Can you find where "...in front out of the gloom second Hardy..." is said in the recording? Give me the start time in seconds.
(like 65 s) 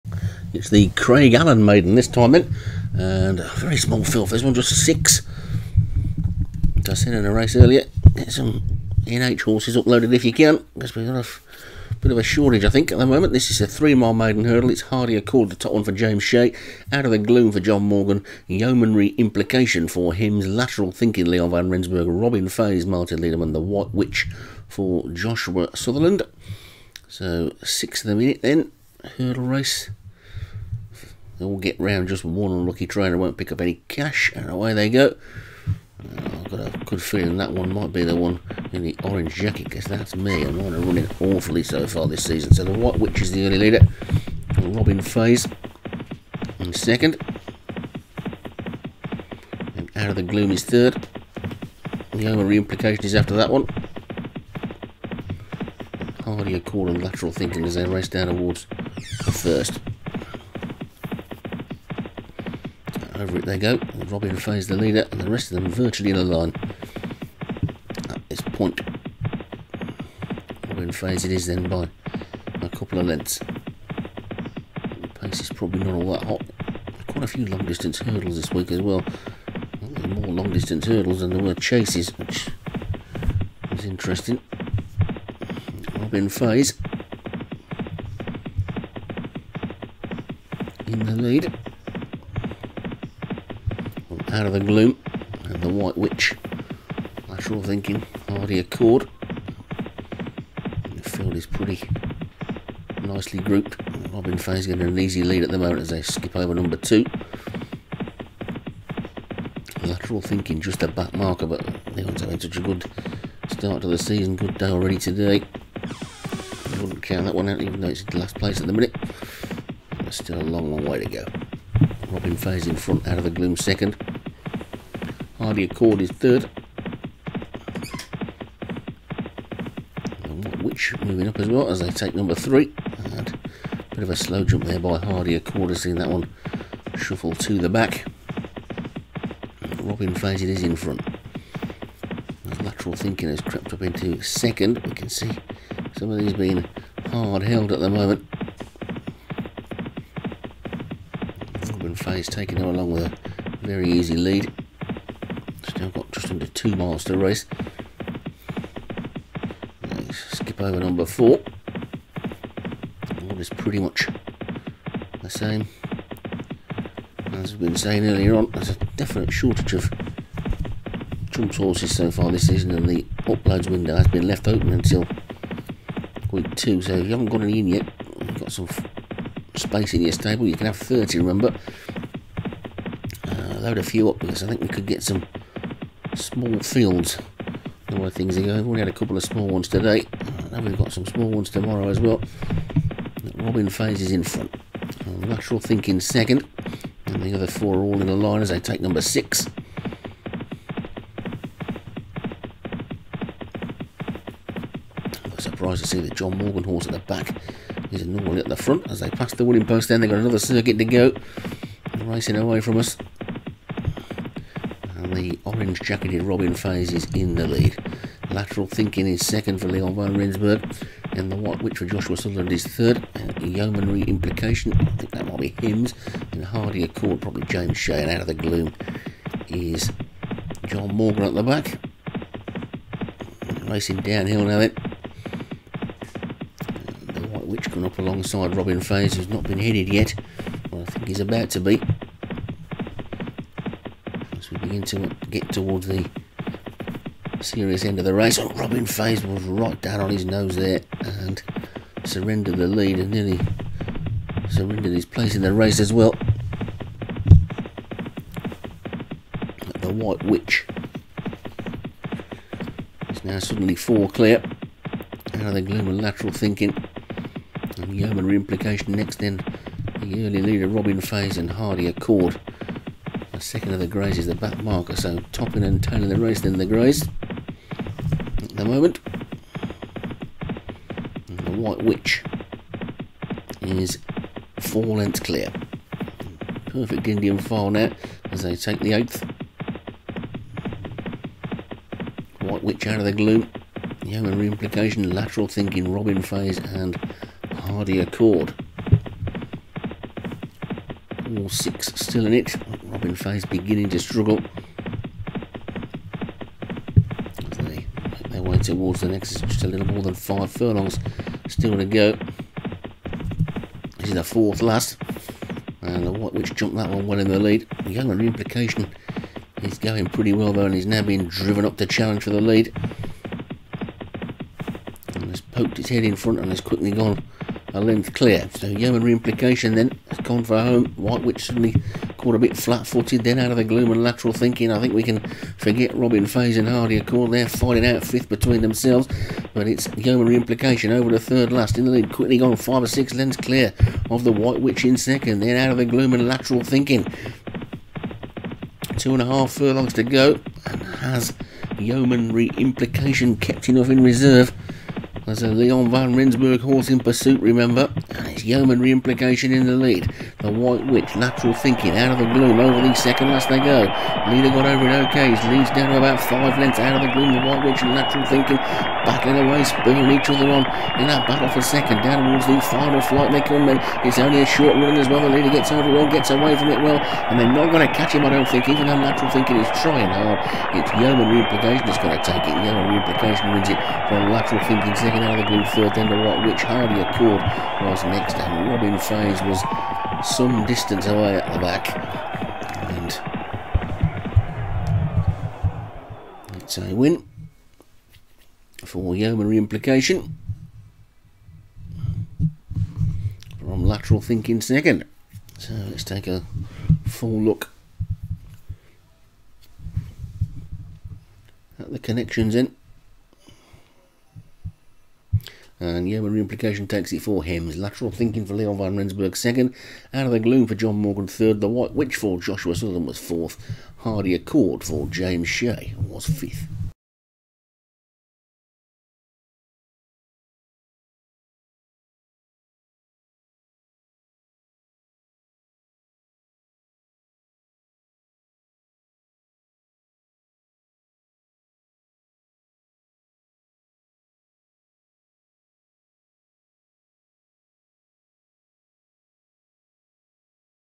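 122 s.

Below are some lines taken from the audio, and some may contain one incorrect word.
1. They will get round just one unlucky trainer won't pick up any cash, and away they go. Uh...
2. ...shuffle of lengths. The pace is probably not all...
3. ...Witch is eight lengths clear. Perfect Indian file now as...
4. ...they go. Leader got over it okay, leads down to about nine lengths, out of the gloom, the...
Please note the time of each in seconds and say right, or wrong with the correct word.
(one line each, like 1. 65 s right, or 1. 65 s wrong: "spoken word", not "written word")
1. 31 s right
2. 72 s wrong: "couple", not "shuffle"
3. 281 s wrong: "four", not "eight"
4. 363 s wrong: "five", not "nine".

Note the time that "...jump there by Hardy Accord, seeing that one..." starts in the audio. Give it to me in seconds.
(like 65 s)
134 s.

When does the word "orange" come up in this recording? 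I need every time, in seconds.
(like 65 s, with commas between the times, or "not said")
39 s, 215 s.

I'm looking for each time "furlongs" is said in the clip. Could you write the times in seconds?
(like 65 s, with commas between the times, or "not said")
310 s, 349 s.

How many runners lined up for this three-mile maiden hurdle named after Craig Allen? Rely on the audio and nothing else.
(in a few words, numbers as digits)
6.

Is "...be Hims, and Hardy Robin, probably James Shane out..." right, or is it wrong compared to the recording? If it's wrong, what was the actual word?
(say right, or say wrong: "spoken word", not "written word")
wrong: "Accord", not "Robin".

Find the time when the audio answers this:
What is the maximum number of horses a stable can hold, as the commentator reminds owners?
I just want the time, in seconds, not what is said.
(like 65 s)
180 s.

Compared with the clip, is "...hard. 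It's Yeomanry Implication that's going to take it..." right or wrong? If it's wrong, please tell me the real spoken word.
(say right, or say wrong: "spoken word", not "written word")
right.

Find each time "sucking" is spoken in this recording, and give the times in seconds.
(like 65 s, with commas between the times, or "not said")
not said.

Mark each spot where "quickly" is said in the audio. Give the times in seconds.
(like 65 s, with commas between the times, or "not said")
326 s, 342 s.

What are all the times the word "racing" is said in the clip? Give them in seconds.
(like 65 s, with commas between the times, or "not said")
212 s, 233 s.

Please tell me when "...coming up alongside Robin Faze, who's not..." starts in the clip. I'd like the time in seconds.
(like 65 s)
237 s.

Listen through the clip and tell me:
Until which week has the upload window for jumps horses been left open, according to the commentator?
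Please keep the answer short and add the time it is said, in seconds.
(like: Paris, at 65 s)
Week 2, at 176 s.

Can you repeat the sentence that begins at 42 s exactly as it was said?
So the White Witch is the early leader, Robin Faze in second, and Out of the Gloom is third.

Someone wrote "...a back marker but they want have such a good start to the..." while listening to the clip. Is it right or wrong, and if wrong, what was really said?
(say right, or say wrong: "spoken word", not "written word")
right.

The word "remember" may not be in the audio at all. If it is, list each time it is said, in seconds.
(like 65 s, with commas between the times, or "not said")
181 s, 357 s.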